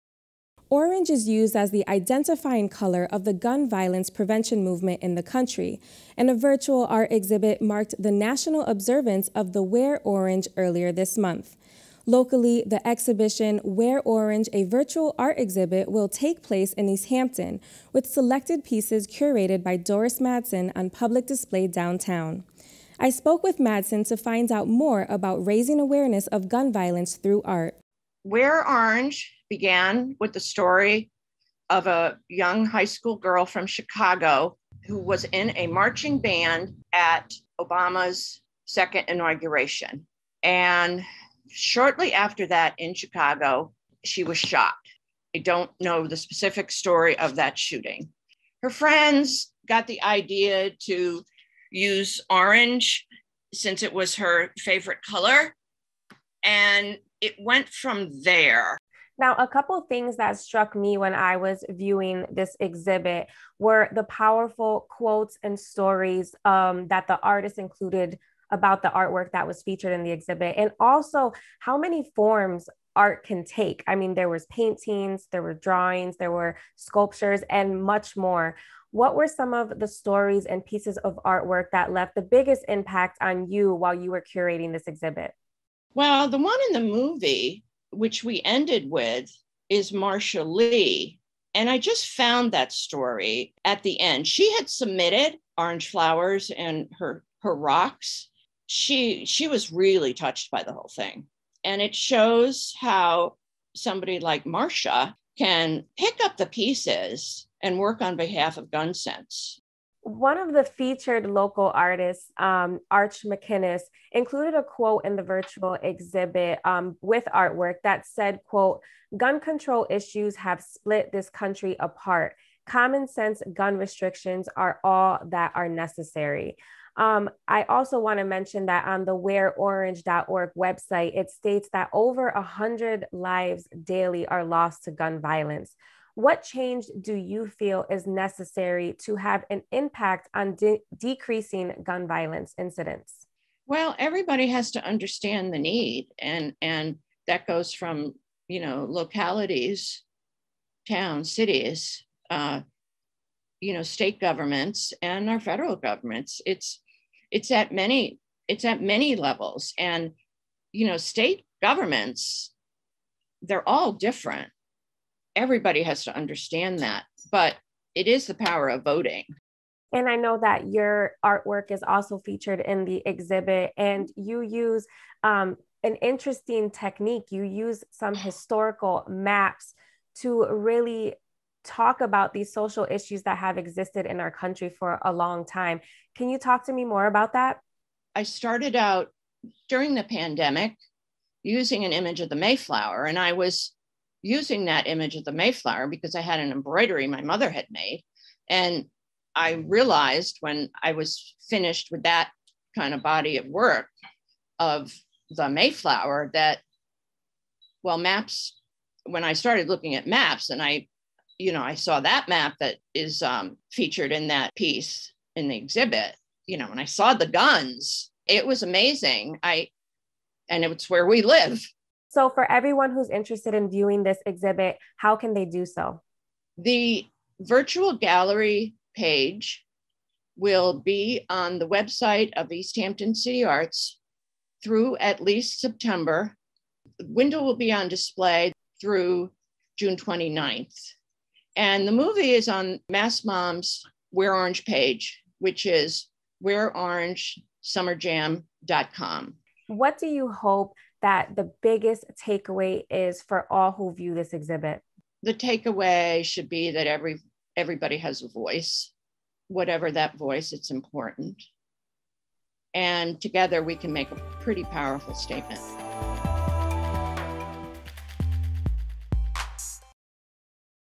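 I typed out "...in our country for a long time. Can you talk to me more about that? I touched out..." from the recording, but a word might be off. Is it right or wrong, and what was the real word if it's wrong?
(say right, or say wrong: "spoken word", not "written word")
wrong: "started", not "touched".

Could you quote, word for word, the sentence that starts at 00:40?
And shortly after that in Chicago, she was shot.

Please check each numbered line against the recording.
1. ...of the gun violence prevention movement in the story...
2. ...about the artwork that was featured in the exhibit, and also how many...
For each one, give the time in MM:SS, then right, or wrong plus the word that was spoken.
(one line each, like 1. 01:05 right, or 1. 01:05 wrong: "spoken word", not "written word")
1. 00:03 wrong: "country", not "story"
2. 01:08 right.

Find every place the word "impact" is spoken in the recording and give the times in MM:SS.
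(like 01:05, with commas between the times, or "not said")
01:22, 02:19.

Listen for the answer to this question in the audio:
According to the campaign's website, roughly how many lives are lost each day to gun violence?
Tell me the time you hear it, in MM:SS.
02:11.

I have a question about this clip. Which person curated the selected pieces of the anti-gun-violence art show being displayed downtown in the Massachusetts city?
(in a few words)
Doris Madsen.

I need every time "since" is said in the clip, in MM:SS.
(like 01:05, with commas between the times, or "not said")
00:53.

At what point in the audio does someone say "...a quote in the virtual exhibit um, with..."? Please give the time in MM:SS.
01:54.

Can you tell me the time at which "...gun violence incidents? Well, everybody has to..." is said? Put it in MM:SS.
02:21.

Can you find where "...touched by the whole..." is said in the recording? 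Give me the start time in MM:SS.
01:40.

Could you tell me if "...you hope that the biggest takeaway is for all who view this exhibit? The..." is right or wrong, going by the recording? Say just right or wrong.
right.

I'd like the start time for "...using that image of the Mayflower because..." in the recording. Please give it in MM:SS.
03:14.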